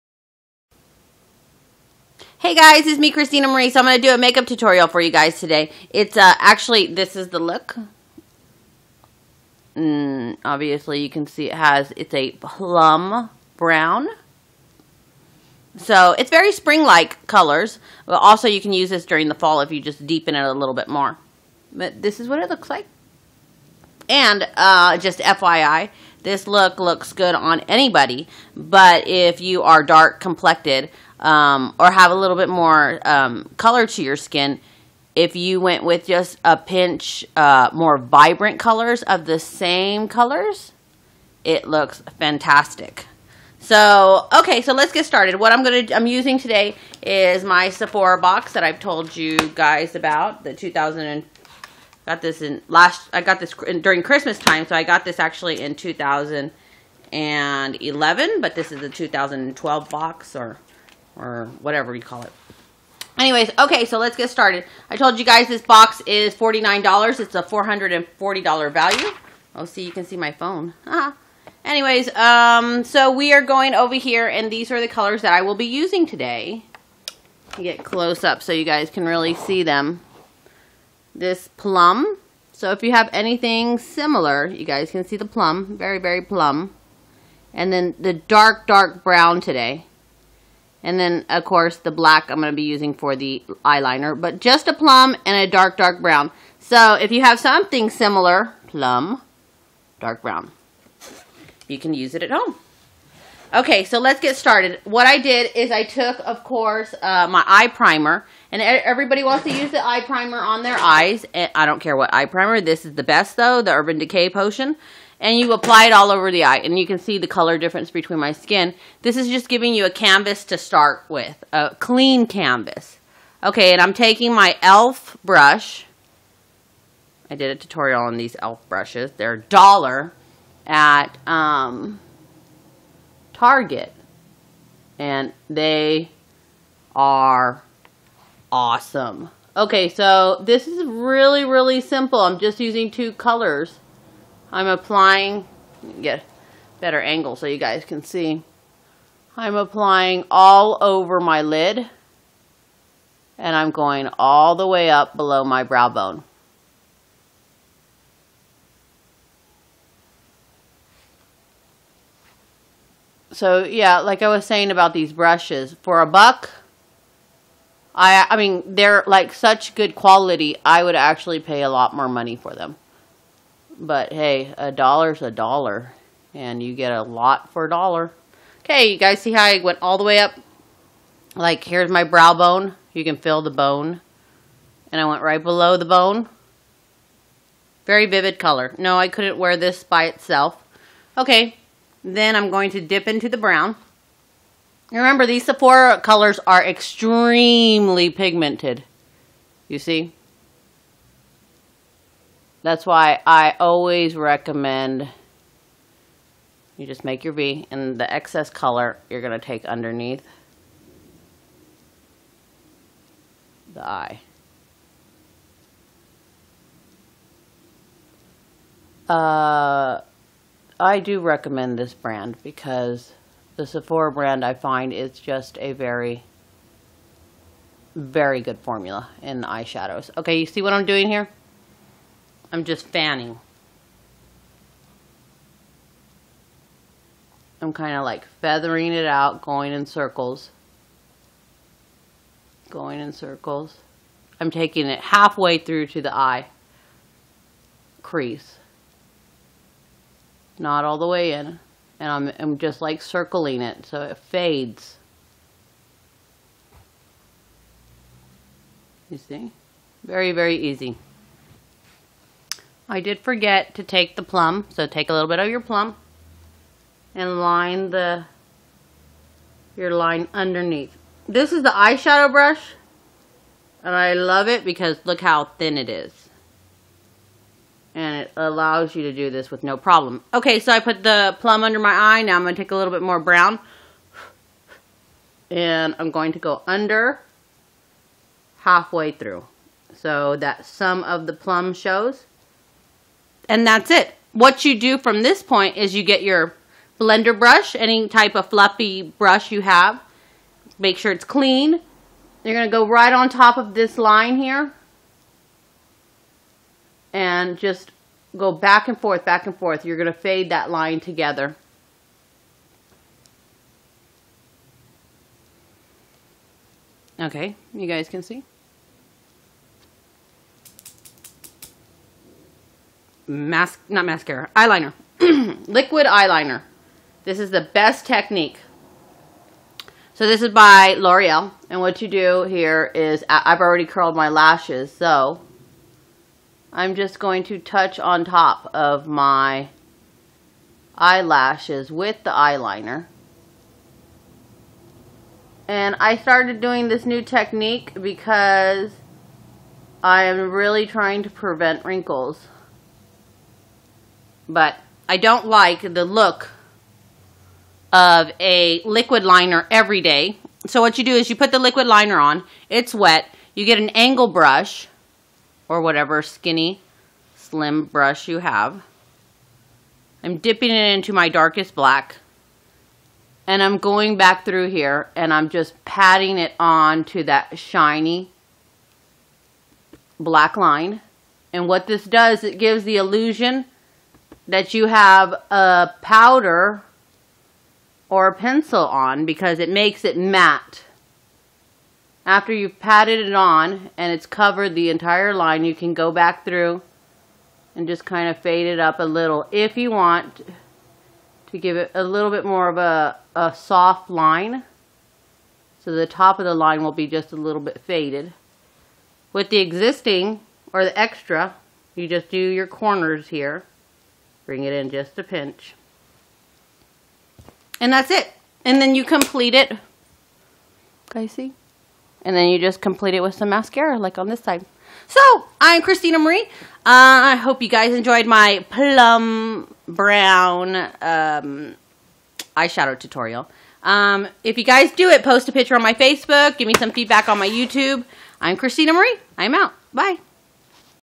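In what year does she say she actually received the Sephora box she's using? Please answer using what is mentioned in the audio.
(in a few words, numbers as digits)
2011.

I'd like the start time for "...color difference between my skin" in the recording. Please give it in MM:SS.
01:57.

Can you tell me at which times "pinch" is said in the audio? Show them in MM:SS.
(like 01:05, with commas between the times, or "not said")
00:36, 06:55.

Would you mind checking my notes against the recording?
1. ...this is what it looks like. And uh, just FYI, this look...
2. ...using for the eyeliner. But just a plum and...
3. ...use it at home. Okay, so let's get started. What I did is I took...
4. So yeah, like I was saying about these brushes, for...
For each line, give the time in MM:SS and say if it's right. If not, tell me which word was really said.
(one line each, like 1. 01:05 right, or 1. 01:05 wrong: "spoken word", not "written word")
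1. 00:22 right
2. 01:32 right
3. 01:41 right
4. 02:43 right.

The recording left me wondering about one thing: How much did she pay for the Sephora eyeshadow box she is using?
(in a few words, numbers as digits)
$49.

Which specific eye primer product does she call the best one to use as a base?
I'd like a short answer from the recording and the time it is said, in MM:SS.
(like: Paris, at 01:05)
Urban Decay Potion, at 01:53.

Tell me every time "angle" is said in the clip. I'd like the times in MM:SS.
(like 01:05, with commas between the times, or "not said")
02:26, 06:03.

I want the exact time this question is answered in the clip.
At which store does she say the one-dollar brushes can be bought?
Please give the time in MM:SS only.
02:13.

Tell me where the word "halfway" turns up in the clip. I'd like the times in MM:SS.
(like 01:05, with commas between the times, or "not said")
04:04, 04:48.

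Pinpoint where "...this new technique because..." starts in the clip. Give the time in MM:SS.
05:46.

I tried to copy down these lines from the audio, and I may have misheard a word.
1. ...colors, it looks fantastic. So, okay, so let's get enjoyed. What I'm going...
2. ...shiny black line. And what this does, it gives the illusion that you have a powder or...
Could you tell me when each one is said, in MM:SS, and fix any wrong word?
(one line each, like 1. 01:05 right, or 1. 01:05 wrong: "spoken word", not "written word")
1. 00:40 wrong: "started", not "enjoyed"
2. 06:17 right.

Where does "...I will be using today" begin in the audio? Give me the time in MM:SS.
01:15.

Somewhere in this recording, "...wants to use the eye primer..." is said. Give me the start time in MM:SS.
01:49.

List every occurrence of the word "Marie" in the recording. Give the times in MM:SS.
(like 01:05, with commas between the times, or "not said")
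00:03, 07:06, 07:18.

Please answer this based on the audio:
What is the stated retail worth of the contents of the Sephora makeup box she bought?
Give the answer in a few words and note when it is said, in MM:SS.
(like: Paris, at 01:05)
$440, at 01:07.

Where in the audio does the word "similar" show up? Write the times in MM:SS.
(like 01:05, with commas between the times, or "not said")
01:23, 01:37.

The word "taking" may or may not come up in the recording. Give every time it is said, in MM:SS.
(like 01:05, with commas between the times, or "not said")
02:03, 04:04.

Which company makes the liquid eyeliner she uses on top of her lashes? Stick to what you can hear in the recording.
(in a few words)
L'Oreal.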